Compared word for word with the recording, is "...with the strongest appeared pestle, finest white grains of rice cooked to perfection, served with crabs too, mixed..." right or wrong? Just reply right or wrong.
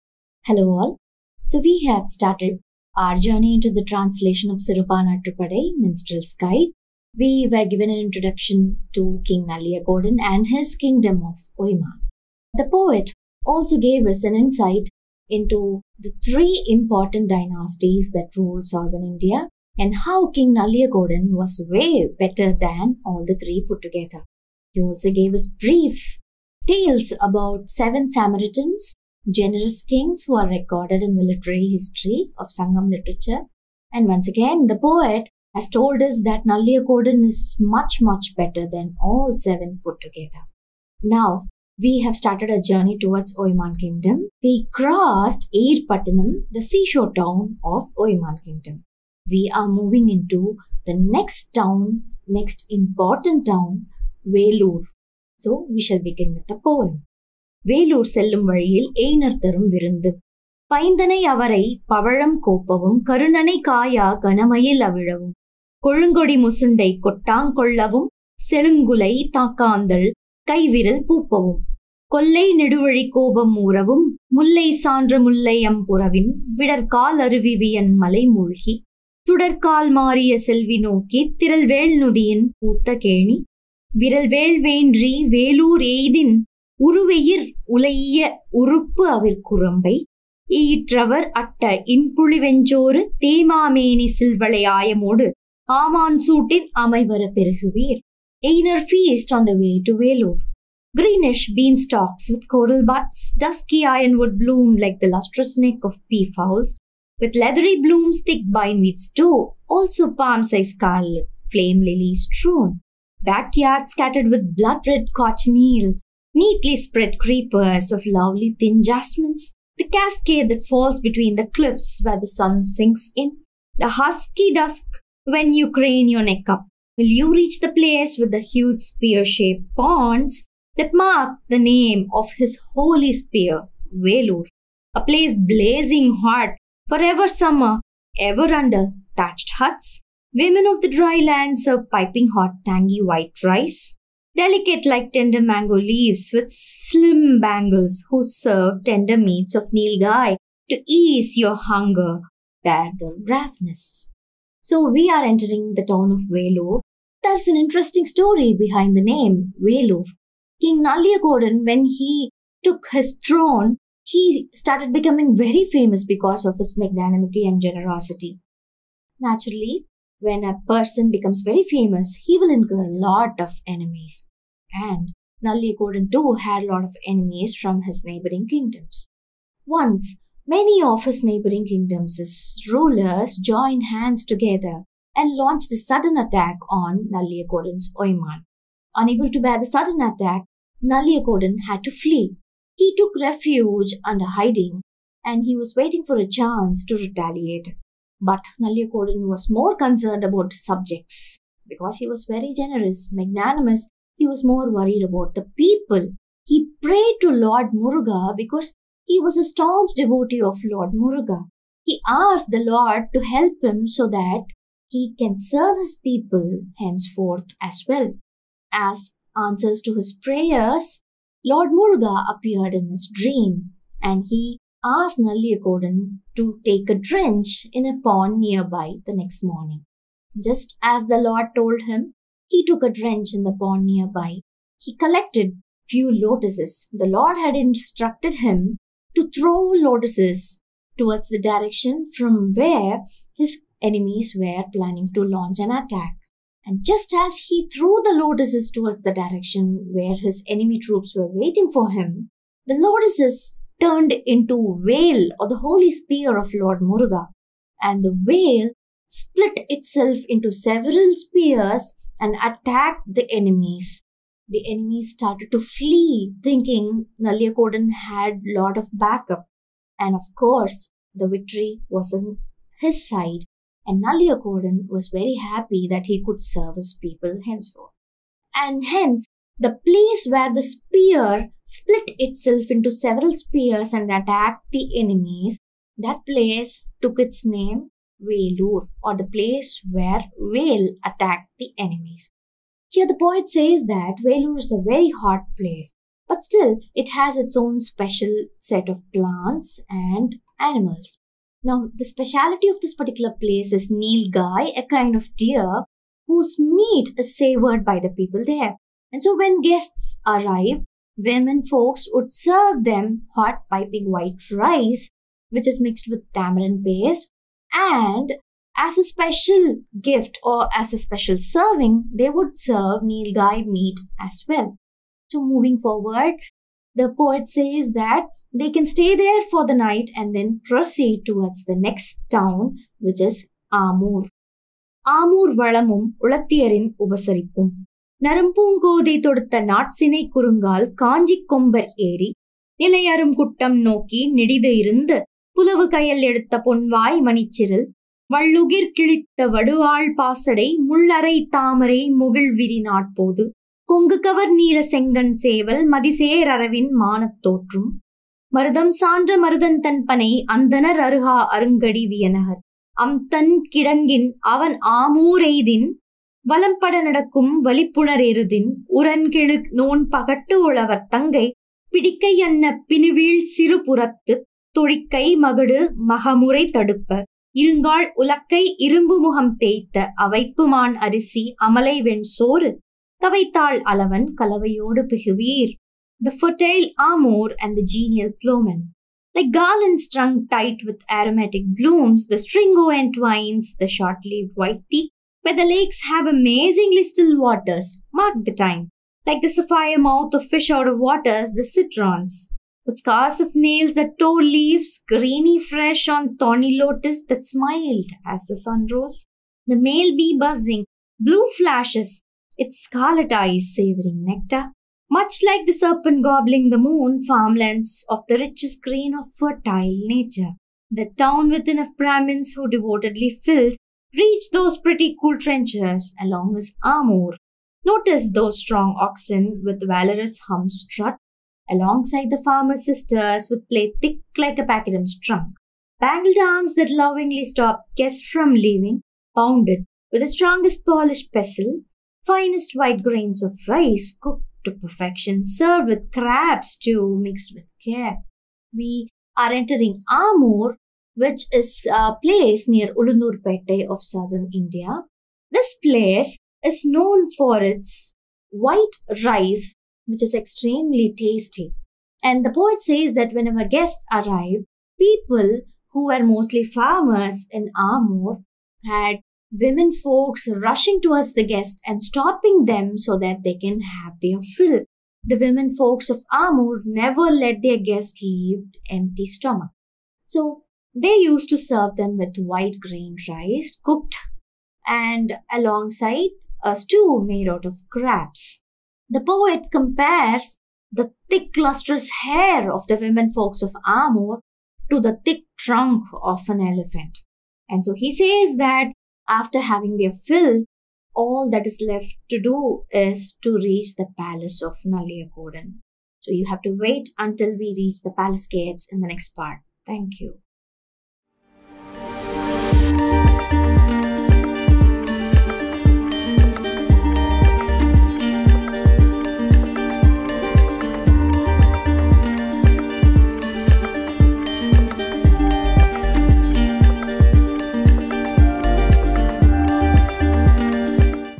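wrong.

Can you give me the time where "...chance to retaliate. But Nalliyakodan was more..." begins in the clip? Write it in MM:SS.
03:16.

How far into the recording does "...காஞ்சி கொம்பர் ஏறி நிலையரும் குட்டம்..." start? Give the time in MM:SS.
05:41.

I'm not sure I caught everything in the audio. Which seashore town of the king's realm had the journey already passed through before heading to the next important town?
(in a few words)
Patanam.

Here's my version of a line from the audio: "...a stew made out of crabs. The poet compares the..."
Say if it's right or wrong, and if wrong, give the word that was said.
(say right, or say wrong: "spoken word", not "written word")
right.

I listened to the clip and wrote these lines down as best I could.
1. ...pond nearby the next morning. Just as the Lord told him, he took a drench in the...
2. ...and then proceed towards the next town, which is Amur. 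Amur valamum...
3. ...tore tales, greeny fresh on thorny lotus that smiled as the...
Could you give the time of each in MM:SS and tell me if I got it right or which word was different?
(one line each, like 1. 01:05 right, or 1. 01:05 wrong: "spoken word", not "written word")
1. 03:48 right
2. 05:30 right
3. 06:44 wrong: "leaves", not "tales".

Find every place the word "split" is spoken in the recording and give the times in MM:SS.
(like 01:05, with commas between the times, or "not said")
04:19, 04:41.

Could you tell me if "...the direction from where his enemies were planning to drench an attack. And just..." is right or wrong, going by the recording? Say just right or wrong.
wrong.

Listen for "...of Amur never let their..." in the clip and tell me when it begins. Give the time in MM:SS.
07:56.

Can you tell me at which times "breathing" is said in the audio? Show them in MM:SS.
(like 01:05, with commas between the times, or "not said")
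not said.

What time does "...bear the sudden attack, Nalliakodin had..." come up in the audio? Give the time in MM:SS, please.
03:09.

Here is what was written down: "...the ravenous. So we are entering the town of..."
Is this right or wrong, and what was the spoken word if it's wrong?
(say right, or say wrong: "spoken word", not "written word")
right.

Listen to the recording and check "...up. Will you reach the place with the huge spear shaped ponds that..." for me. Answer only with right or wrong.
right.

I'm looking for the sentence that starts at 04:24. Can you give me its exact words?
The enemies started to flee, thinking Nalliyakodan had lot of backup.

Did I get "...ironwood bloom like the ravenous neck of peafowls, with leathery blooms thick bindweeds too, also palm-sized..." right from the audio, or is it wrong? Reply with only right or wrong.
wrong.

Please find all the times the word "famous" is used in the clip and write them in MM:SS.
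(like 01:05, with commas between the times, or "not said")
02:45, 02:51.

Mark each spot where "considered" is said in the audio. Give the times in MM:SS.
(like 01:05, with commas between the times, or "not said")
not said.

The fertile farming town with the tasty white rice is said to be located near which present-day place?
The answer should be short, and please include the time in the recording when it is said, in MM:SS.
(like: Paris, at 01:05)
Ulundurpet, at 07:32.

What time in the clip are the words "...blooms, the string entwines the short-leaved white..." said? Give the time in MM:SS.
06:31.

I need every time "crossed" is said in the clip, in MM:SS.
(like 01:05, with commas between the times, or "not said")
00:44.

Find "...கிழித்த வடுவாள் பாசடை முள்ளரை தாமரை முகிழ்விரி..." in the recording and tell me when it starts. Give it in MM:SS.
05:48.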